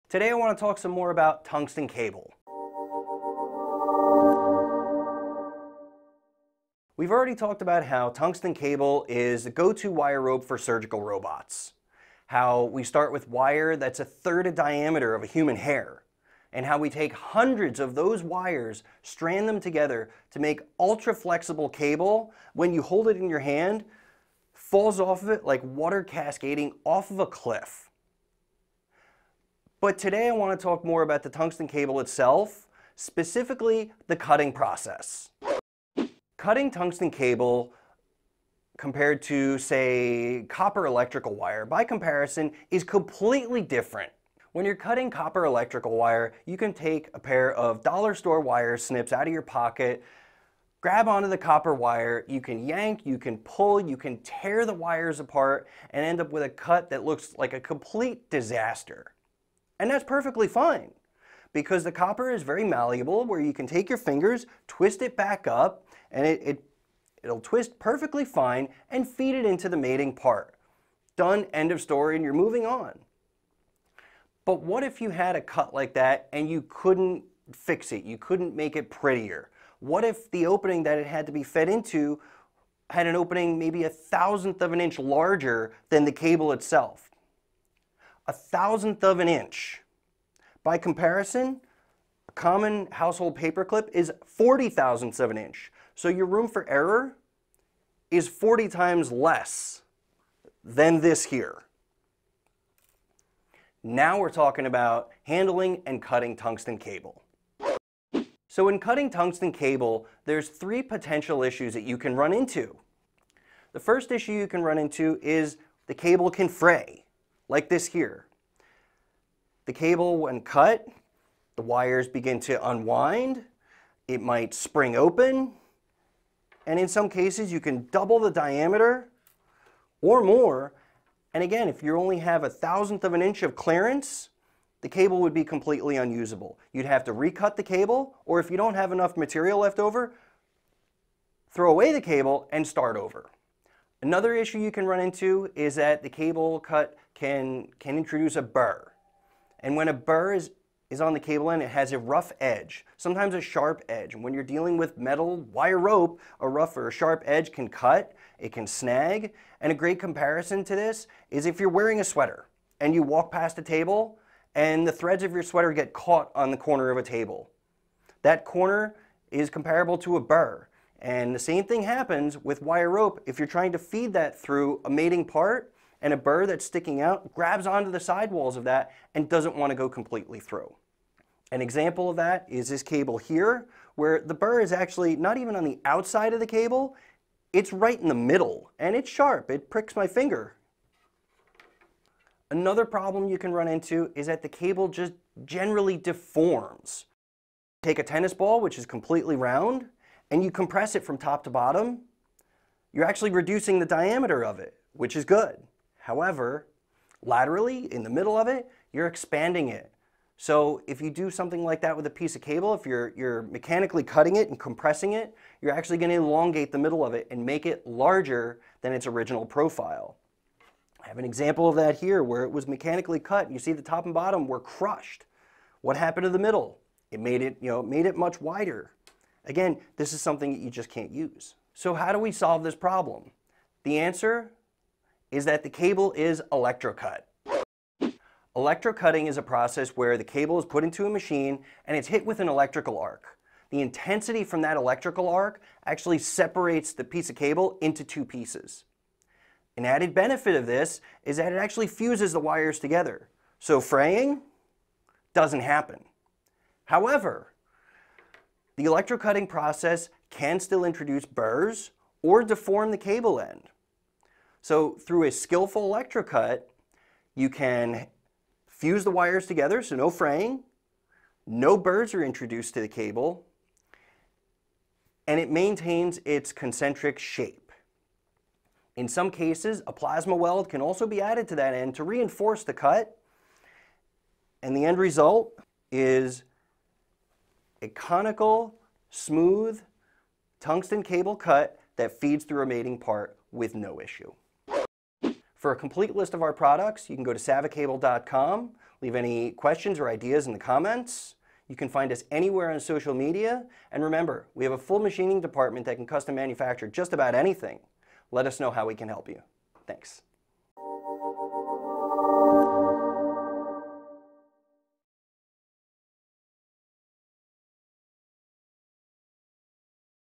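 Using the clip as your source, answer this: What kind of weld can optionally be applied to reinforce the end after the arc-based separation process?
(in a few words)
plasma weld.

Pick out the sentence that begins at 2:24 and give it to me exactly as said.
Another issue you can run into is that the cable cut can, can introduce a burr.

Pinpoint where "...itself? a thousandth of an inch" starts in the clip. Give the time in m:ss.
1:26.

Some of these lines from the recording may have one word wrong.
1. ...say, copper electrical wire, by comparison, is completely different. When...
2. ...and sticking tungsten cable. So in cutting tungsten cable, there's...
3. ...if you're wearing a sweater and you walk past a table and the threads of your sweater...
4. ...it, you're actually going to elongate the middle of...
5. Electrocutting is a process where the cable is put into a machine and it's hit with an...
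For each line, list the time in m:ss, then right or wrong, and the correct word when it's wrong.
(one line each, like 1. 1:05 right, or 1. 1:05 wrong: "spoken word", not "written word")
1. 0:39 right
2. 1:45 wrong: "cutting", not "sticking"
3. 2:41 right
4. 3:35 right
5. 3:58 right.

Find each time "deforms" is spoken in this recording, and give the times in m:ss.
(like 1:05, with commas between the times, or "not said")
3:15, 4:22.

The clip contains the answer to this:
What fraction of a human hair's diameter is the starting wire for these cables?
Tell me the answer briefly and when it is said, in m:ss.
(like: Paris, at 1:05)
a third, at 0:14.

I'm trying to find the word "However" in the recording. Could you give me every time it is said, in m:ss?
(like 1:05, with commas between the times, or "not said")
3:25, 4:16.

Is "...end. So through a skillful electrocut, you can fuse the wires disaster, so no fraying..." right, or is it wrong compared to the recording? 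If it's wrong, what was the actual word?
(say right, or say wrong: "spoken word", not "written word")
wrong: "together", not "disaster".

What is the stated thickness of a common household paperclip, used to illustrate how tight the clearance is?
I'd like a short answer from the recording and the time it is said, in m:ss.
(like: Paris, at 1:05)
40 thousandths of an inch, at 1:34.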